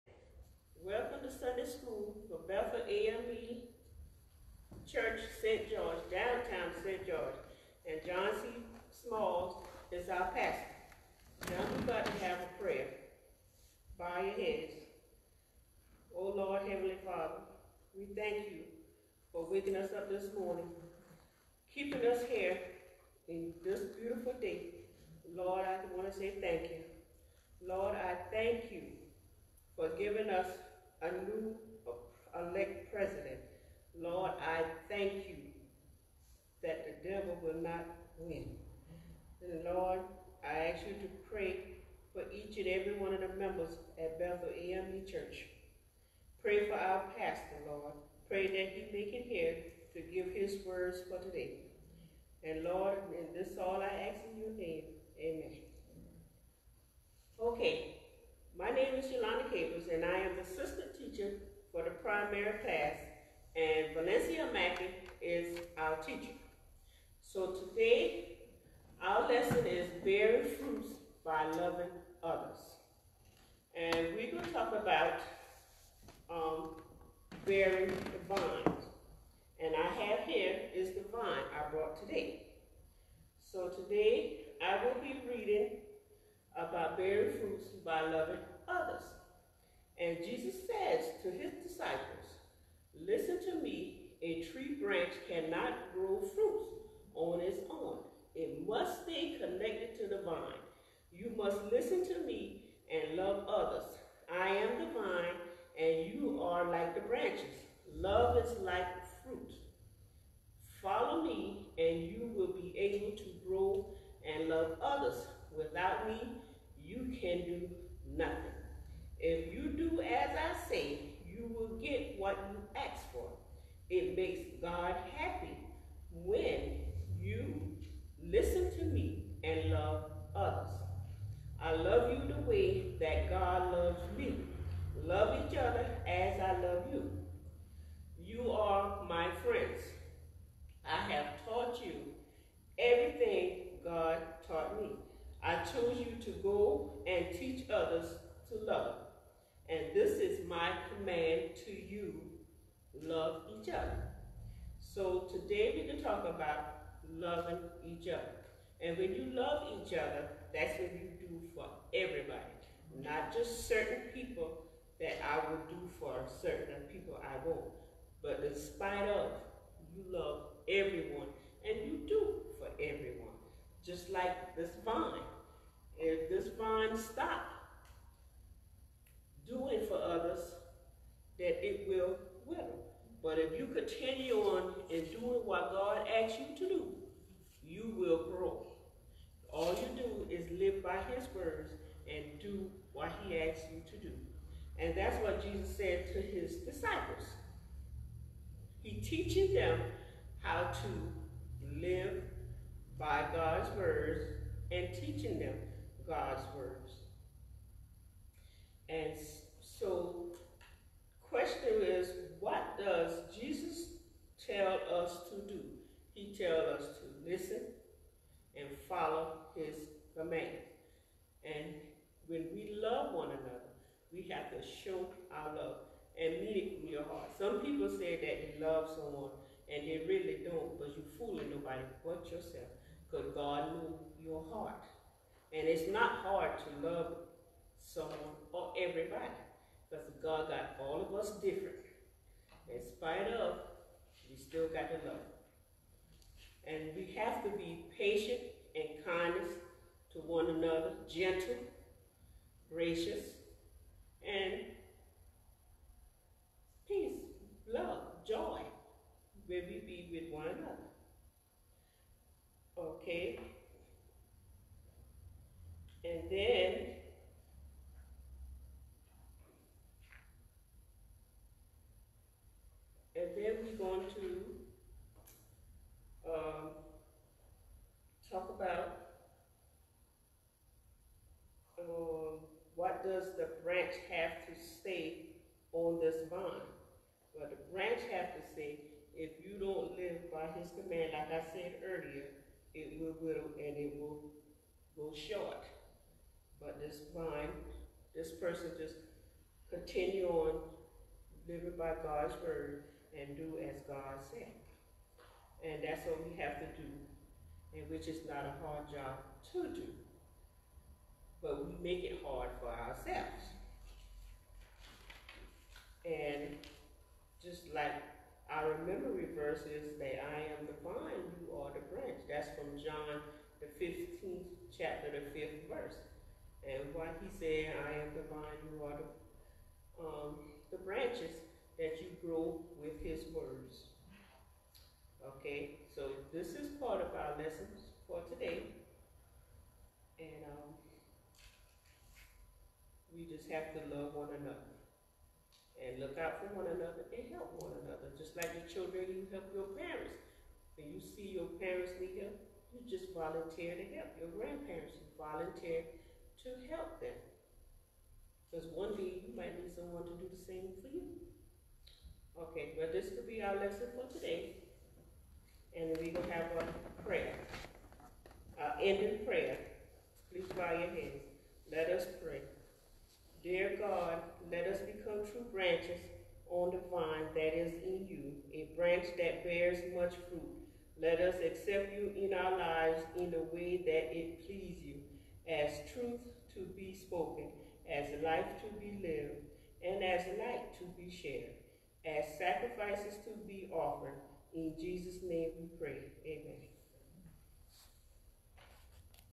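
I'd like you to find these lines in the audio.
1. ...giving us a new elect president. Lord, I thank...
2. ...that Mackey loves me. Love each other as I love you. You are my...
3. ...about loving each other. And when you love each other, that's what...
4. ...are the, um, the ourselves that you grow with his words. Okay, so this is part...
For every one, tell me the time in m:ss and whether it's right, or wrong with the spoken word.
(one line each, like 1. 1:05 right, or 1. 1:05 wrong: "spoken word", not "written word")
1. 0:29 right
2. 2:12 wrong: "God", not "Mackey"
3. 2:36 right
4. 5:28 wrong: "branches", not "ourselves".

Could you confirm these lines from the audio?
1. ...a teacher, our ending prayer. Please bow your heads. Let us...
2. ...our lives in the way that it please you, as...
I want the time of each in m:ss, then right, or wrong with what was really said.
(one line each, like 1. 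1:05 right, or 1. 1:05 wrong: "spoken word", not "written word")
1. 6:06 wrong: "prayer", not "teacher"
2. 6:22 right.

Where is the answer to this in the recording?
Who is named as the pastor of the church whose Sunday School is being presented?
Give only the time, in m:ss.
0:08.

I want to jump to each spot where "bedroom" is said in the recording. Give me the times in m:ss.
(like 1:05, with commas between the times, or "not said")
not said.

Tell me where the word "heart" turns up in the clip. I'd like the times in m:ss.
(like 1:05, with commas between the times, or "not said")
3:47, 3:54.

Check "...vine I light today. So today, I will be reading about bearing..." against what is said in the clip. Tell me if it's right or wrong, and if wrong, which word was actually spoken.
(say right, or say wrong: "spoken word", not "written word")
wrong: "brought", not "light".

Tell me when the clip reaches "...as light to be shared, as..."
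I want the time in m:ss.
6:30.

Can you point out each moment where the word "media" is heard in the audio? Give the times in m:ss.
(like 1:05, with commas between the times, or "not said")
not said.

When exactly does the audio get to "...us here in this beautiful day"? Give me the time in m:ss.
0:22.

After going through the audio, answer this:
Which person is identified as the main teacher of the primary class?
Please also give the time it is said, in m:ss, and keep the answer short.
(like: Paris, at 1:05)
Valencia Mackey, at 1:03.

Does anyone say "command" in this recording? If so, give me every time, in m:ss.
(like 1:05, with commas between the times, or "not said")
2:30, 3:40, 4:50.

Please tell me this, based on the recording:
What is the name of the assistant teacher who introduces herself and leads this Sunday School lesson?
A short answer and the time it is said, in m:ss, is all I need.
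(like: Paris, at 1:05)
Yolanda Capers, at 0:59.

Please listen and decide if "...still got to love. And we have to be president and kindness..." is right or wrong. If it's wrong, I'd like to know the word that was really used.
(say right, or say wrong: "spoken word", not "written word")
wrong: "patient", not "president".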